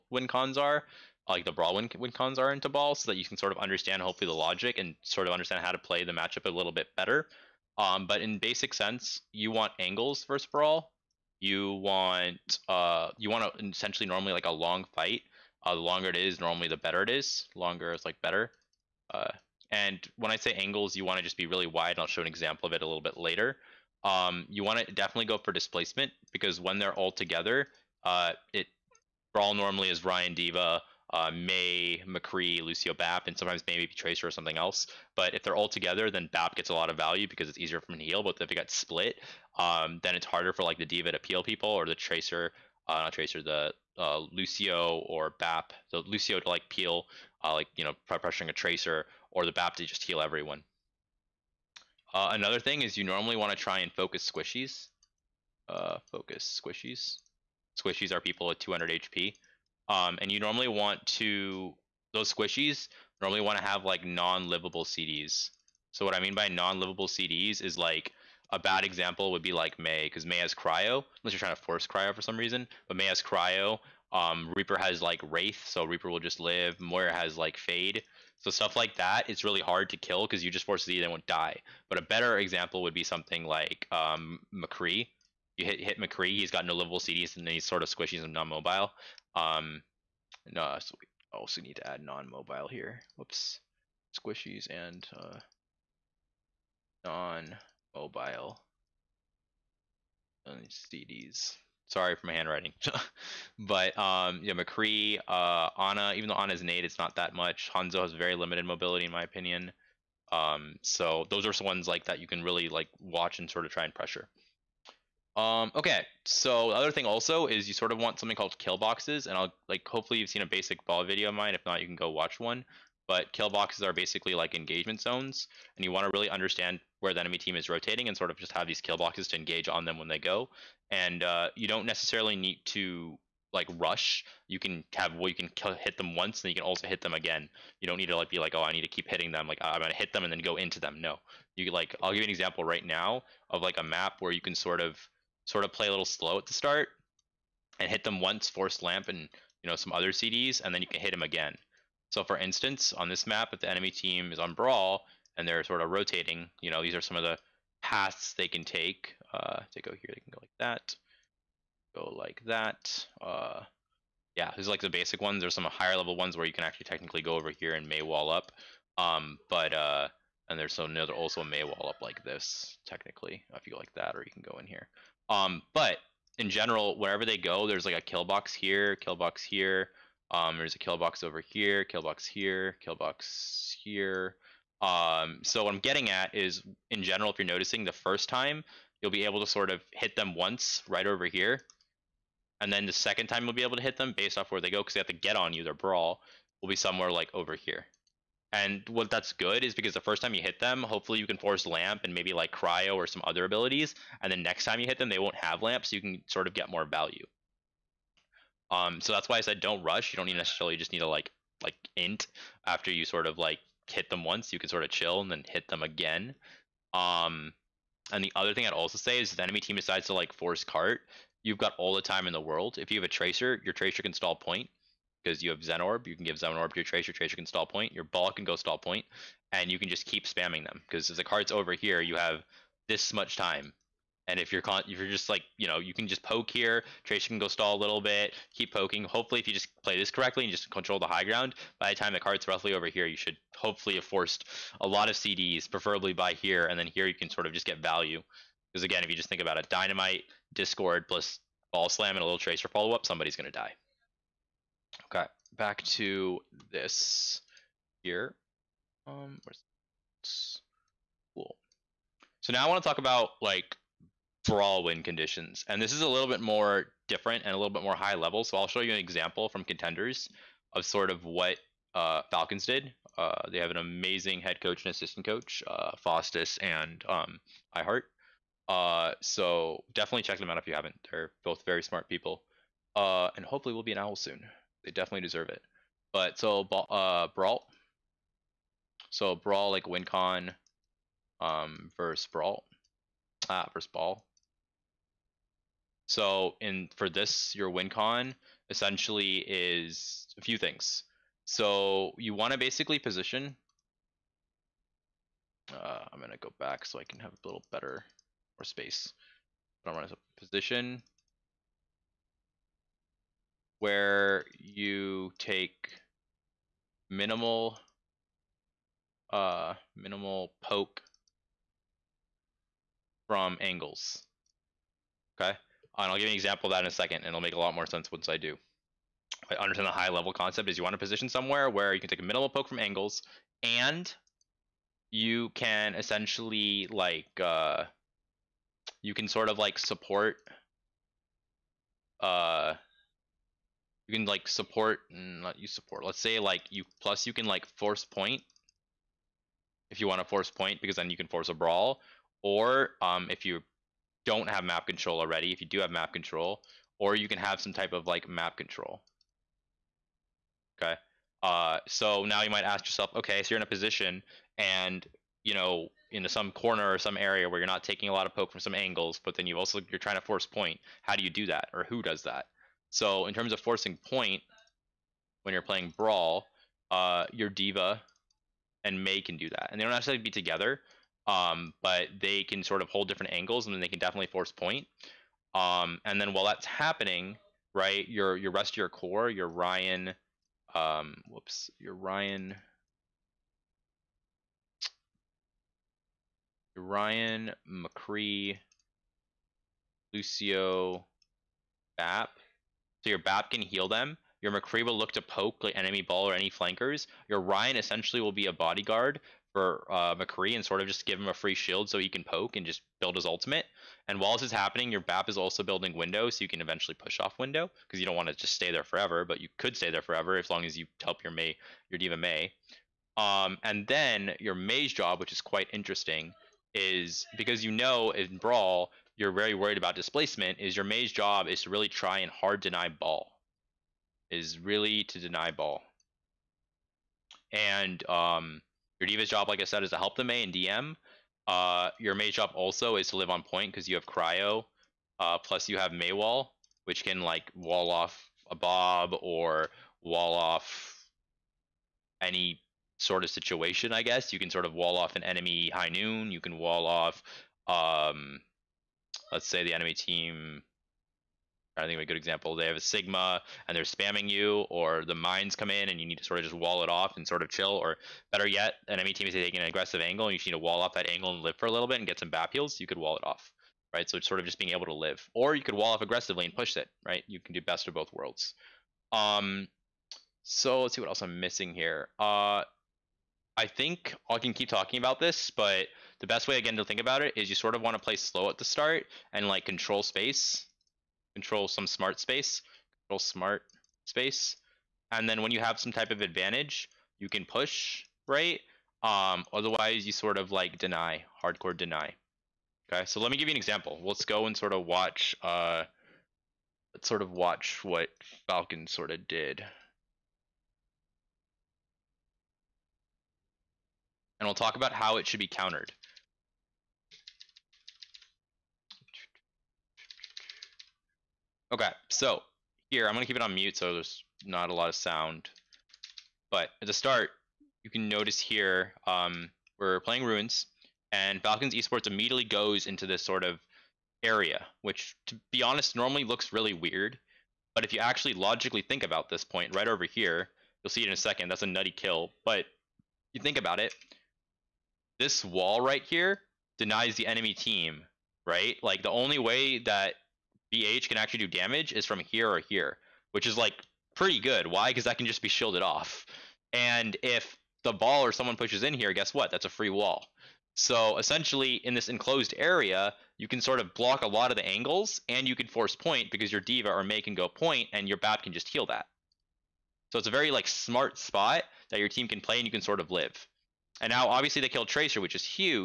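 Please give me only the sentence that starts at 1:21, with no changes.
But a better example would be something like um, McCree.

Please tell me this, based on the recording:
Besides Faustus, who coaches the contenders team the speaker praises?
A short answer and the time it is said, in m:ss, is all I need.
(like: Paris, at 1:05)
iHeart, at 4:37.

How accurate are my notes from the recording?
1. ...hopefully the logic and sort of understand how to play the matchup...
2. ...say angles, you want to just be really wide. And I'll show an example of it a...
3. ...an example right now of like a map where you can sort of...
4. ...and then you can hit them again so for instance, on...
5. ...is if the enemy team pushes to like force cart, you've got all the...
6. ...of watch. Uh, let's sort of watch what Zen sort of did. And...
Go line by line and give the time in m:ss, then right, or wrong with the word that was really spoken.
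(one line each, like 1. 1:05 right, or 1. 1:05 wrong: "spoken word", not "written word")
1. 0:04 right
2. 0:20 right
3. 2:22 right
4. 2:30 right
5. 3:39 wrong: "decides", not "pushes"
6. 8:24 wrong: "Falcon", not "Zen".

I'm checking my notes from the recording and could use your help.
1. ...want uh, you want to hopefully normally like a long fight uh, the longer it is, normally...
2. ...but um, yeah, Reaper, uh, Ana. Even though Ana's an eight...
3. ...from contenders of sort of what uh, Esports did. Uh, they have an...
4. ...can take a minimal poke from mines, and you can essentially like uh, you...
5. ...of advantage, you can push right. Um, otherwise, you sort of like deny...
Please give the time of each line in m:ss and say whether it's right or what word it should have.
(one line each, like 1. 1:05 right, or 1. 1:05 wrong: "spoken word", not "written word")
1. 0:11 wrong: "essentially", not "hopefully"
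2. 1:43 wrong: "McCree", not "Reaper"
3. 4:29 wrong: "Falcons", not "Esports"
4. 5:31 wrong: "angles", not "mines"
5. 8:16 right.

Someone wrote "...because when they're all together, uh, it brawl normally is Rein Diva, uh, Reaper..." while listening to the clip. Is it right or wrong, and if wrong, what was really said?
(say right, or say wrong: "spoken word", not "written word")
wrong: "Mei", not "Reaper".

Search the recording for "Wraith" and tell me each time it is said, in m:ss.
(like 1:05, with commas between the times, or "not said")
1:15.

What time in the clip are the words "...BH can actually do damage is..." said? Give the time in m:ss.
9:10.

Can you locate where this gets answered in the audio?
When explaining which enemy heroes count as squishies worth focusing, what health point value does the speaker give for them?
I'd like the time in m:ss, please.
0:58.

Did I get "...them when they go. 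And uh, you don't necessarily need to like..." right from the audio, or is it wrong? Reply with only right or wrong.
right.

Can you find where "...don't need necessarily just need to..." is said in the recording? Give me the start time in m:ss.
3:30.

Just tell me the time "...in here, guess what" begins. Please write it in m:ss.
9:18.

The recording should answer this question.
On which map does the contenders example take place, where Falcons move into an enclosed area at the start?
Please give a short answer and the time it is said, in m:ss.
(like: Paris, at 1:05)
Ruins, at 8:50.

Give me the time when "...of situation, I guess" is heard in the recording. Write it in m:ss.
7:33.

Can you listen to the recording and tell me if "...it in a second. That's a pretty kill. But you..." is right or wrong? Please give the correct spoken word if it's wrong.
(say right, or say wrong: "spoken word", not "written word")
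wrong: "nutty", not "pretty".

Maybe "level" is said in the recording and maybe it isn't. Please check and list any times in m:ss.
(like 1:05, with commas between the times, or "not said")
2:45, 4:28, 5:30.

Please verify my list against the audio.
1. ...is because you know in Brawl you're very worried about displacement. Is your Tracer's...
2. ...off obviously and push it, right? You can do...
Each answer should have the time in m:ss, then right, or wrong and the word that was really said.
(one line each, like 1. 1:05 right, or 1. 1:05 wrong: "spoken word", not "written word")
1. 7:06 wrong: "Mei", not "Tracer"
2. 7:55 wrong: "aggressively", not "obviously".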